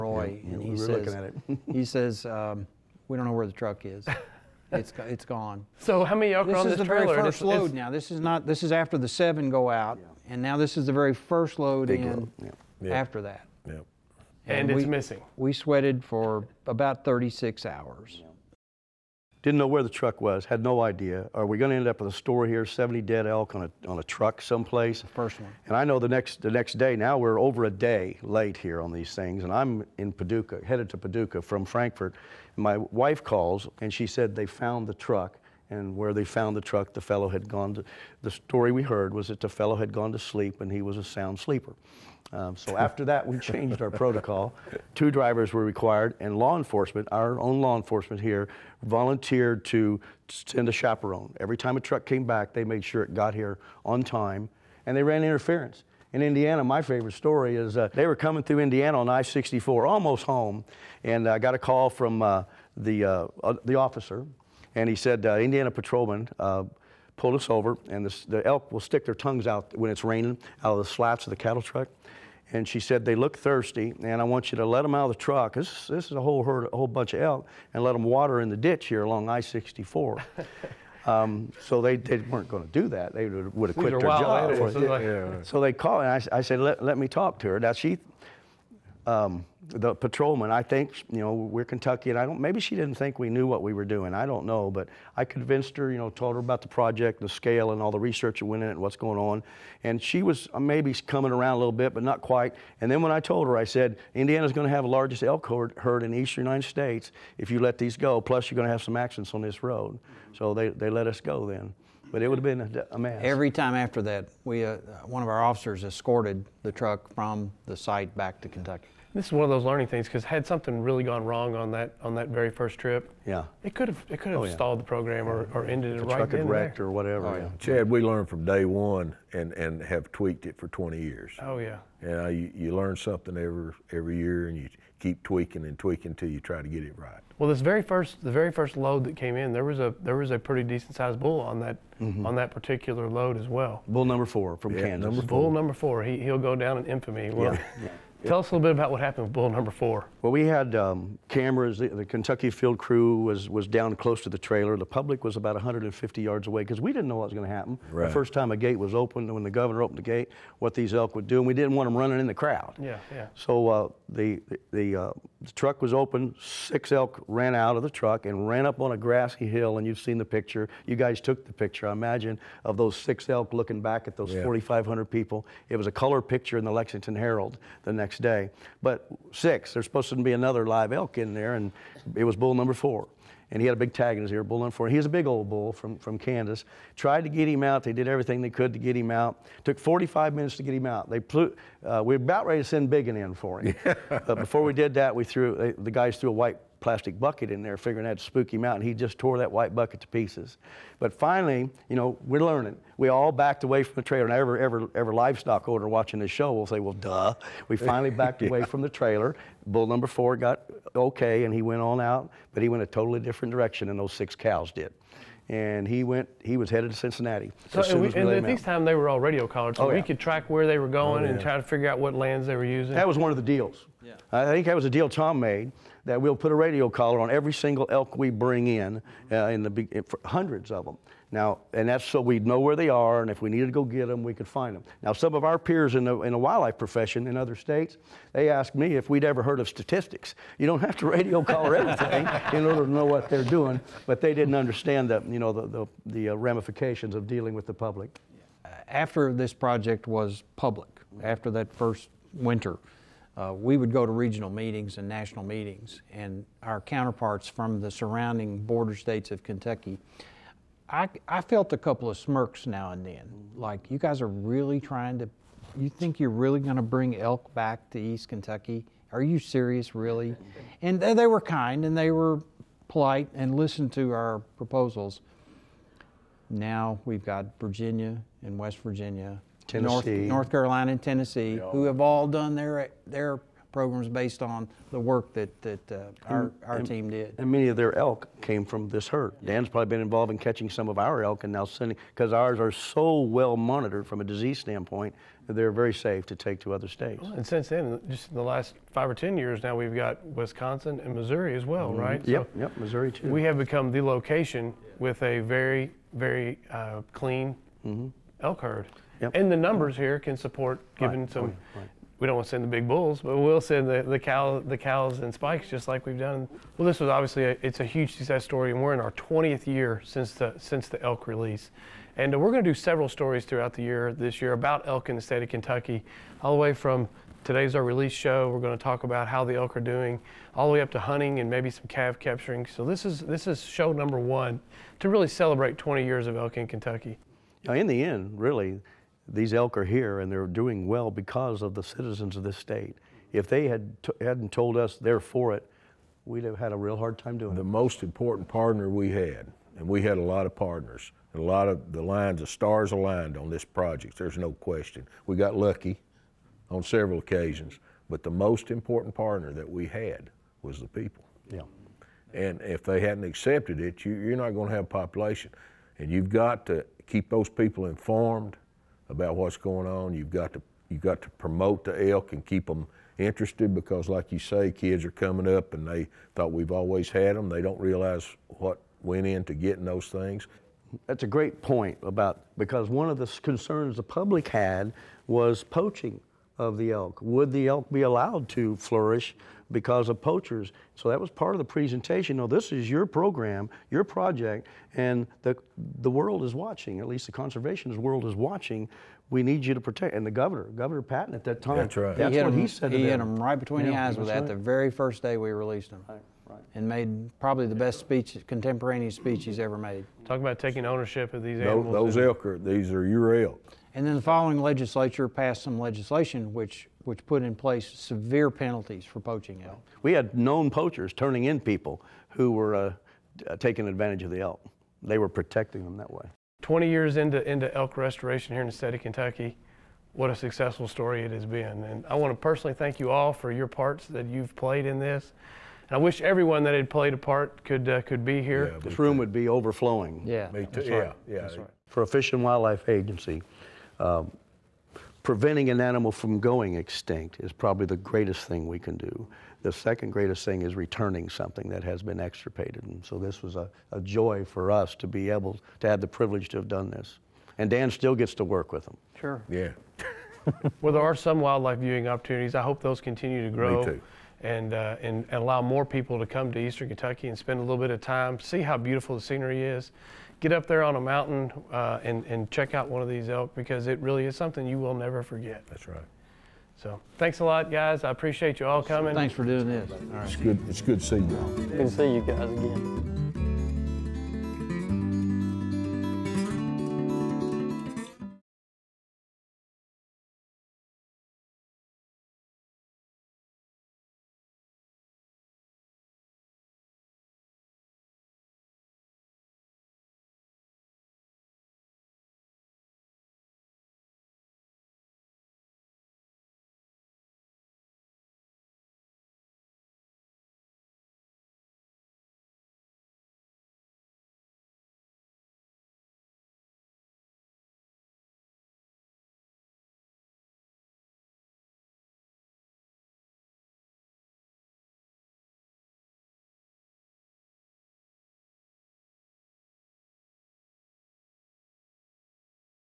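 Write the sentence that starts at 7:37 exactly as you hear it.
And Dan still gets to work with them.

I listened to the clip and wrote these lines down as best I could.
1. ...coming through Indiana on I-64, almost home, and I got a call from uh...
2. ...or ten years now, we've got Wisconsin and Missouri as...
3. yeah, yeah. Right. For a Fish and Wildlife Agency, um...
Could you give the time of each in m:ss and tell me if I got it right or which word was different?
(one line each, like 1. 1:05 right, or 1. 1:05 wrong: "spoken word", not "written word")
1. 0:58 right
2. 4:59 right
3. 7:20 right.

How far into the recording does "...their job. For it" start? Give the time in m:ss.
1:23.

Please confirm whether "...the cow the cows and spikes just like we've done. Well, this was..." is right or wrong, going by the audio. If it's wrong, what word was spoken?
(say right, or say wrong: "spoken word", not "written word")
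right.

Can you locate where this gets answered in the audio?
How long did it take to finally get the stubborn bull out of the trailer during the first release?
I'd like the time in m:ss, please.
3:09.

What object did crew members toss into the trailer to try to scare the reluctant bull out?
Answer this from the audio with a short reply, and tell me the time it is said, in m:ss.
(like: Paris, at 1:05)
White plastic bucket, at 3:16.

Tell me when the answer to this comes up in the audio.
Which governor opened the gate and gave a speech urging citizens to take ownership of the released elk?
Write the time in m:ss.
6:40.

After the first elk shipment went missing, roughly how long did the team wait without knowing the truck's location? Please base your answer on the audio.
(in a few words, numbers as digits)
36.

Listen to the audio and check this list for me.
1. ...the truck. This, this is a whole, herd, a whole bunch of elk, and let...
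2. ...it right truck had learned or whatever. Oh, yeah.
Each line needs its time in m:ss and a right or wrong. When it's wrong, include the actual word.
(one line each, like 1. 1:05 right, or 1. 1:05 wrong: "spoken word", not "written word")
1. 1:15 right
2. 2:06 wrong: "wrecked", not "learned".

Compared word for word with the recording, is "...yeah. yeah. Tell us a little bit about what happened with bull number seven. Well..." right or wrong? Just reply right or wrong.
wrong.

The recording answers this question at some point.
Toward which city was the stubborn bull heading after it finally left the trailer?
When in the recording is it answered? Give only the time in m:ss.
3:36.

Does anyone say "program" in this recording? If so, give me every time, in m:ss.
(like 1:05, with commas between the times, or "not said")
2:04, 4:43, 6:33.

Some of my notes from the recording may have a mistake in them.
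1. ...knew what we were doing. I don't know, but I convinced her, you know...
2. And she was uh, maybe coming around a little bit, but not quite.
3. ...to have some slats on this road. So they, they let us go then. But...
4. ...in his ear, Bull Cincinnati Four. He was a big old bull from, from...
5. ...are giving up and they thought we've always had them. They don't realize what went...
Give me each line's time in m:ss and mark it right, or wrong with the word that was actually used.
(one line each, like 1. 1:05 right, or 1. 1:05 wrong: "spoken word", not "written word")
1. 1:33 right
2. 1:39 right
3. 1:48 wrong: "accidents", not "slats"
4. 3:04 wrong: "Number", not "Cincinnati"
5. 6:15 wrong: "coming", not "giving".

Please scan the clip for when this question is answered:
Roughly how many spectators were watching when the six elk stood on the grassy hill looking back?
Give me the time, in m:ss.
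2:54.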